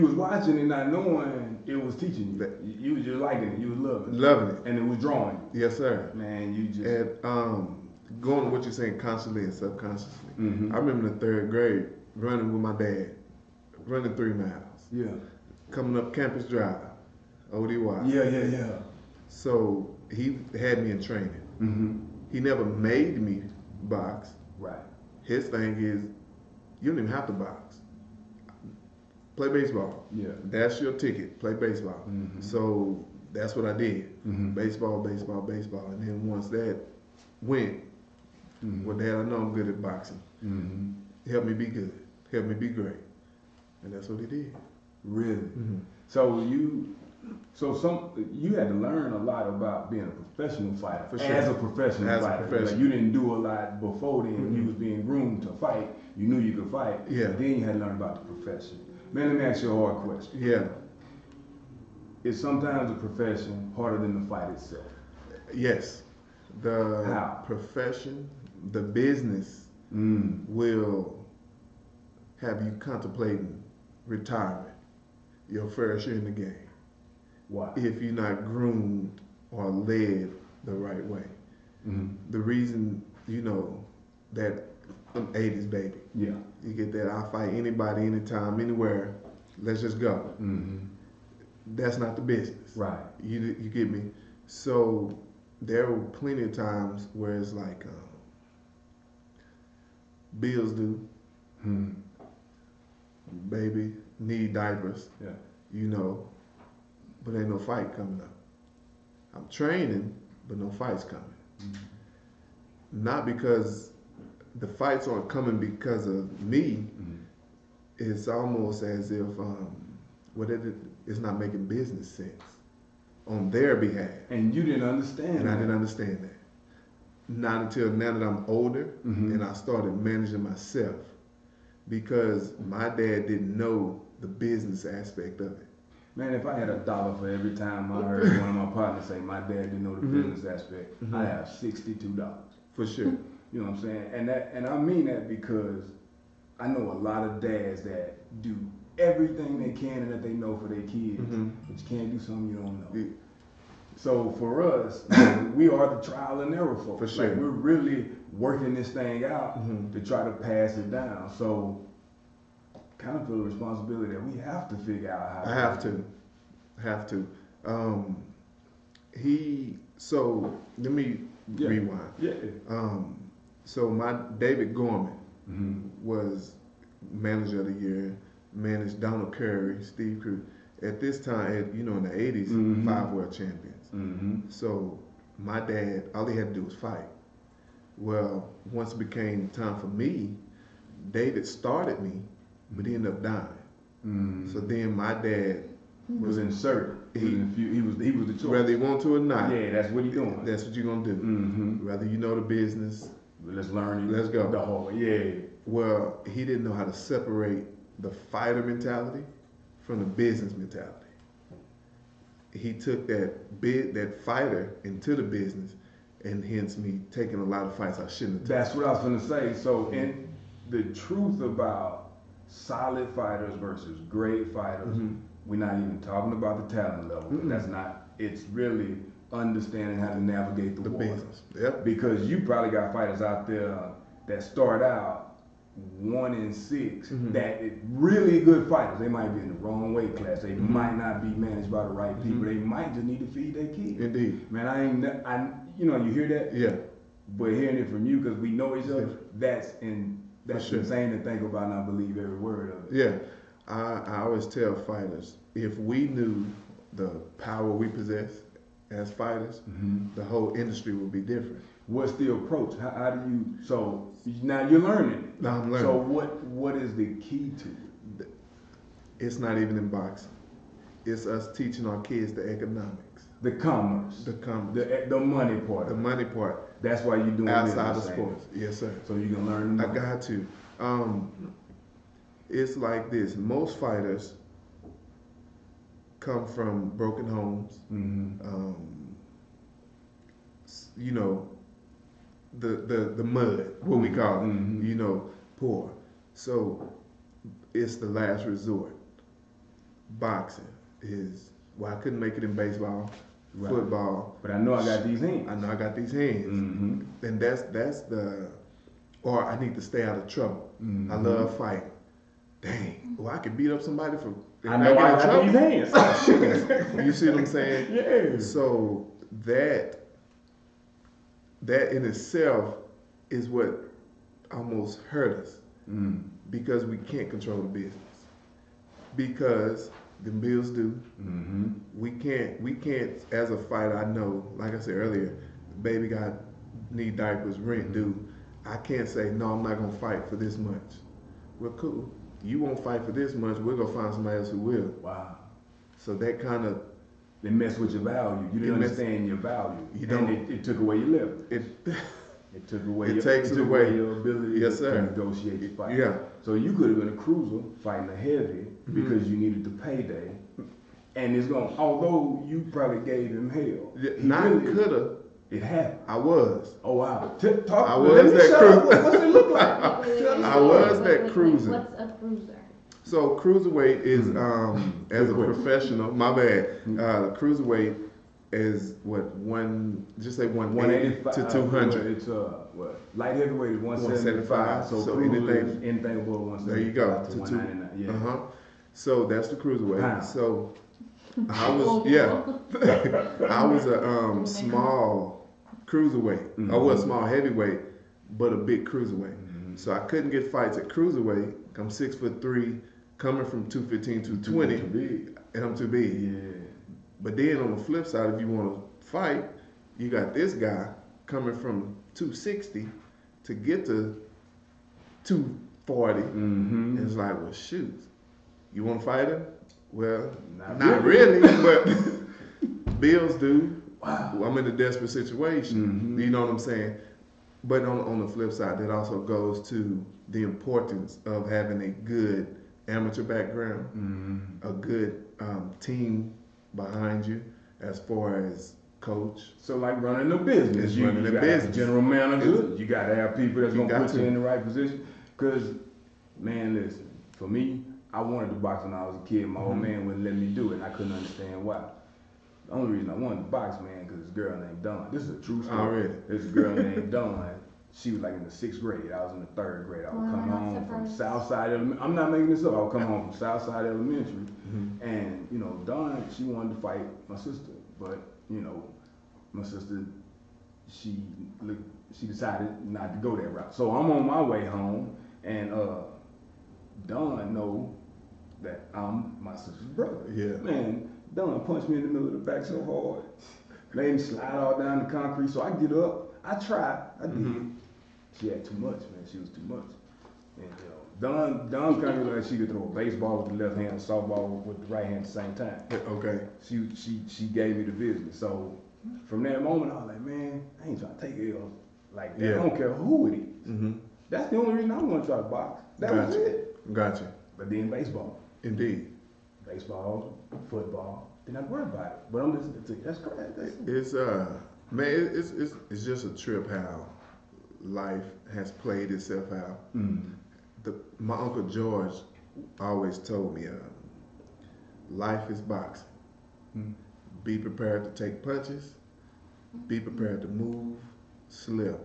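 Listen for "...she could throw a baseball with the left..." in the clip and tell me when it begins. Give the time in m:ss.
8:12.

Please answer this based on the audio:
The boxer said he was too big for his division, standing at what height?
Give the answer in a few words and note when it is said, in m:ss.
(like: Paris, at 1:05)
6 foot 3, at 6:41.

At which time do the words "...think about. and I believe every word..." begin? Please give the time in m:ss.
4:11.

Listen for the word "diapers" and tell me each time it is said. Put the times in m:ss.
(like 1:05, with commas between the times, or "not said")
1:44, 5:37.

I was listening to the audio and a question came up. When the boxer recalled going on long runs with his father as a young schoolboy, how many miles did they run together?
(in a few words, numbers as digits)
3.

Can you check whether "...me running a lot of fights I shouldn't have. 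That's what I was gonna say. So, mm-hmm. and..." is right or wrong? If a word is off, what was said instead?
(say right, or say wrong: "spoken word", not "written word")
wrong: "taking", not "running".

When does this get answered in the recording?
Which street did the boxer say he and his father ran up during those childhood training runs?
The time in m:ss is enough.
0:16.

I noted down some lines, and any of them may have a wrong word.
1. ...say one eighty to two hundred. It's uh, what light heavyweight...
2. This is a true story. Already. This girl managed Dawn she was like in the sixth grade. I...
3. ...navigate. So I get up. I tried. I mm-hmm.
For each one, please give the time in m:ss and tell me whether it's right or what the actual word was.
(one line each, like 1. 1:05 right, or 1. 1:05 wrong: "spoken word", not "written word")
1. 6:20 right
2. 7:35 wrong: "named", not "managed"
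3. 8:05 wrong: "concrete", not "navigate".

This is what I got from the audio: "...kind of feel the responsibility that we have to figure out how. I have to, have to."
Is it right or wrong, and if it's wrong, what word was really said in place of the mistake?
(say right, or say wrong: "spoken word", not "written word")
right.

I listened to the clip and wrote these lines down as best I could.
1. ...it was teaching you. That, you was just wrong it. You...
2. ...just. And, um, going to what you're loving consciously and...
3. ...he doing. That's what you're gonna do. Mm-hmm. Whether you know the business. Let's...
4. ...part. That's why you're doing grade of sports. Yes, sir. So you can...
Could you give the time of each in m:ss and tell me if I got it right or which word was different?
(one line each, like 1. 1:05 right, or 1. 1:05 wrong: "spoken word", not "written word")
1. 0:01 wrong: "liking", not "wrong"
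2. 0:06 wrong: "saying", not "loving"
3. 3:20 right
4. 4:36 wrong: "outside", not "grade".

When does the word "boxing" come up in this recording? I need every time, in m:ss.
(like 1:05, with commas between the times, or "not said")
0:39, 4:29, 5:00, 8:45.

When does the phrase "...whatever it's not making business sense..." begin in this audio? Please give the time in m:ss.
2:00.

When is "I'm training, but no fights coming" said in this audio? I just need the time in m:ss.
1:49.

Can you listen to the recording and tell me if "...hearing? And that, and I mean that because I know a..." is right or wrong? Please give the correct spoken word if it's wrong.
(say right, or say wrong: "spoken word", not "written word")
wrong: "saying", not "hearing".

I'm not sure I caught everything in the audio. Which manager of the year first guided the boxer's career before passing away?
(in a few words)
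David Gorman.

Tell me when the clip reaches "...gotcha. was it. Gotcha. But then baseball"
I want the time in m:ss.
8:26.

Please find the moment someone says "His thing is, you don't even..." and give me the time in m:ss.
0:25.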